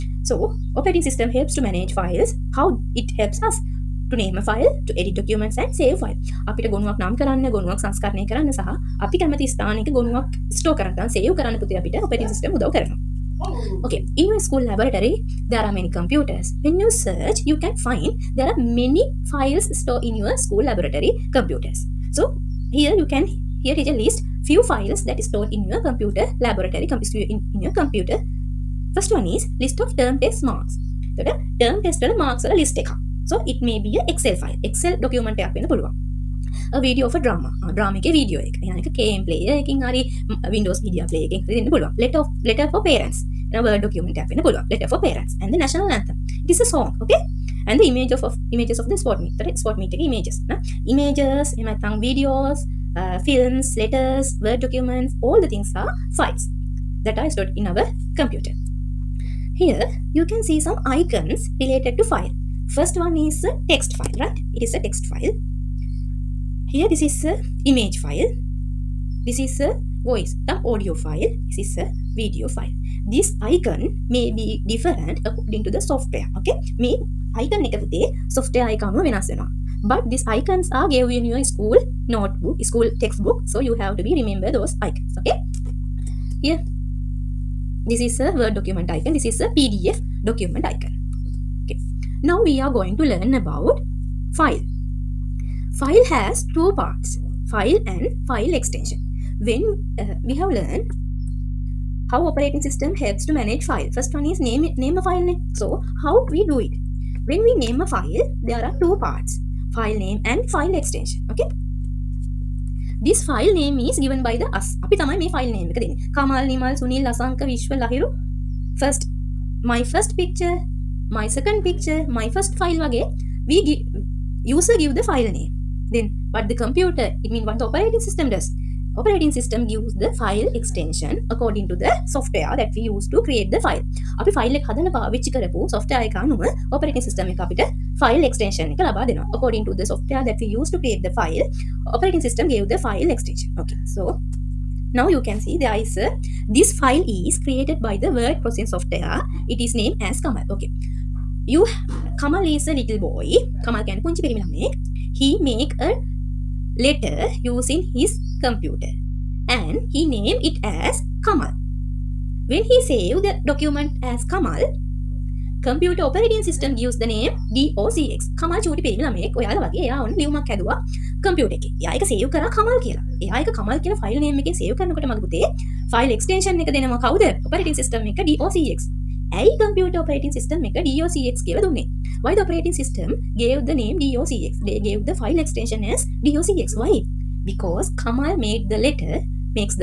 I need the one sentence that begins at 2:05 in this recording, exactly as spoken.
Then what the computer, it means what the operating system does.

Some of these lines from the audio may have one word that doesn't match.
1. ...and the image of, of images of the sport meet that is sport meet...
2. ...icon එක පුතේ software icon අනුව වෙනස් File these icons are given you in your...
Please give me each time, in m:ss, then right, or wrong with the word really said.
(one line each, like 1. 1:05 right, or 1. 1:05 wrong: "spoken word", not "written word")
1. 0:47 right
2. 1:17 wrong: "But", not "File".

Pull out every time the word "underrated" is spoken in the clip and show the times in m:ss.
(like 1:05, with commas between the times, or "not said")
not said.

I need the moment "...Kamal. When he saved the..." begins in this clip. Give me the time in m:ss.
2:41.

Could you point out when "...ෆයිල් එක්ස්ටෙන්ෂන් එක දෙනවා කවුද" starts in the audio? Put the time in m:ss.
2:55.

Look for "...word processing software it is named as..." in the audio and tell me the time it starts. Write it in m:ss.
2:28.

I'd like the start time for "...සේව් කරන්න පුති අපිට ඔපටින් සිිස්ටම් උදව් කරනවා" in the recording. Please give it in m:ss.
0:11.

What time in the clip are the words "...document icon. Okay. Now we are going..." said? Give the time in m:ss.
1:30.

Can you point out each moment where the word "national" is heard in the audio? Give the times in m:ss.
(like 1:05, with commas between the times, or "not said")
0:45.